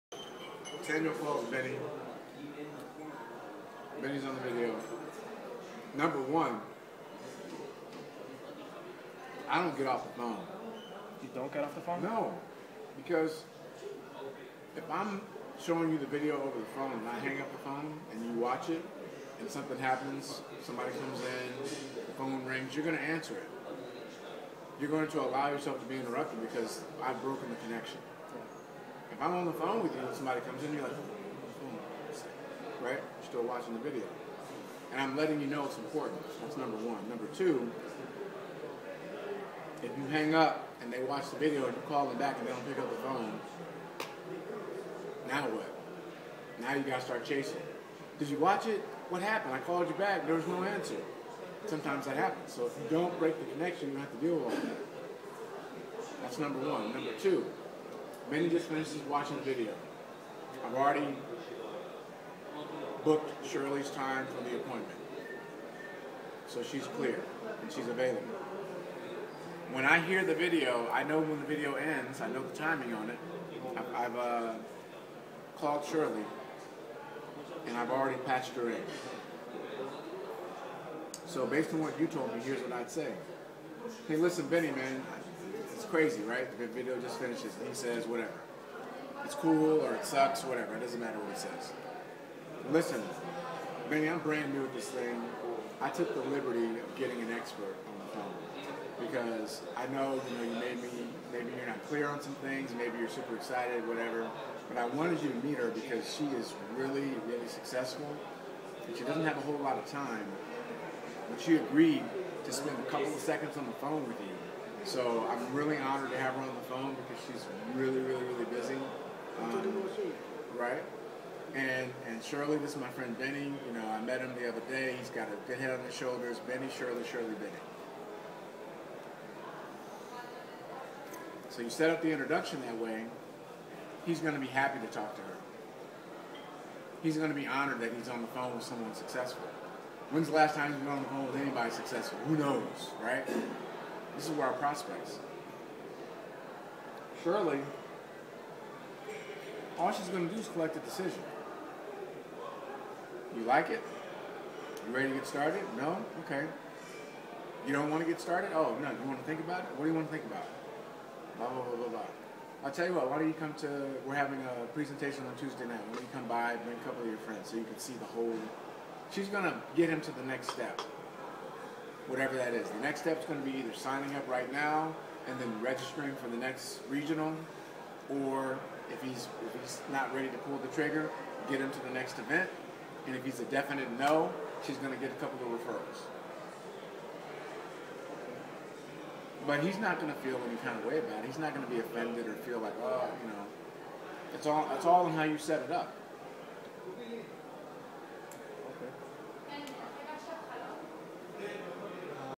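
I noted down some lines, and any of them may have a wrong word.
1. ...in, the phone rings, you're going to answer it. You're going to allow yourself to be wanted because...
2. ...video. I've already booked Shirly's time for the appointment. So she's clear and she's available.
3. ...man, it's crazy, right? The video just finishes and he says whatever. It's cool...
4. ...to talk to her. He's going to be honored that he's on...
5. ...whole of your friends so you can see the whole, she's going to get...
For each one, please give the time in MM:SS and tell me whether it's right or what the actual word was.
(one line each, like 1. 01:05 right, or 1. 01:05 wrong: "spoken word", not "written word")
1. 00:21 wrong: "interrupted", not "wanted"
2. 00:59 right
3. 01:24 right
4. 02:14 right
5. 02:46 wrong: "couple", not "whole".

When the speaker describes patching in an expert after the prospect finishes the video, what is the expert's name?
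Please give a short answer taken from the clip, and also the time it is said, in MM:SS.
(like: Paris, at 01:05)
Shirley, at 01:15.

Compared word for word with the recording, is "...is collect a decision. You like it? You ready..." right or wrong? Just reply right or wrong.
right.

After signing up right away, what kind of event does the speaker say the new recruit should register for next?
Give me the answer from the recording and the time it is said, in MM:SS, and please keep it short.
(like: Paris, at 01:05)
the next regional, at 02:56.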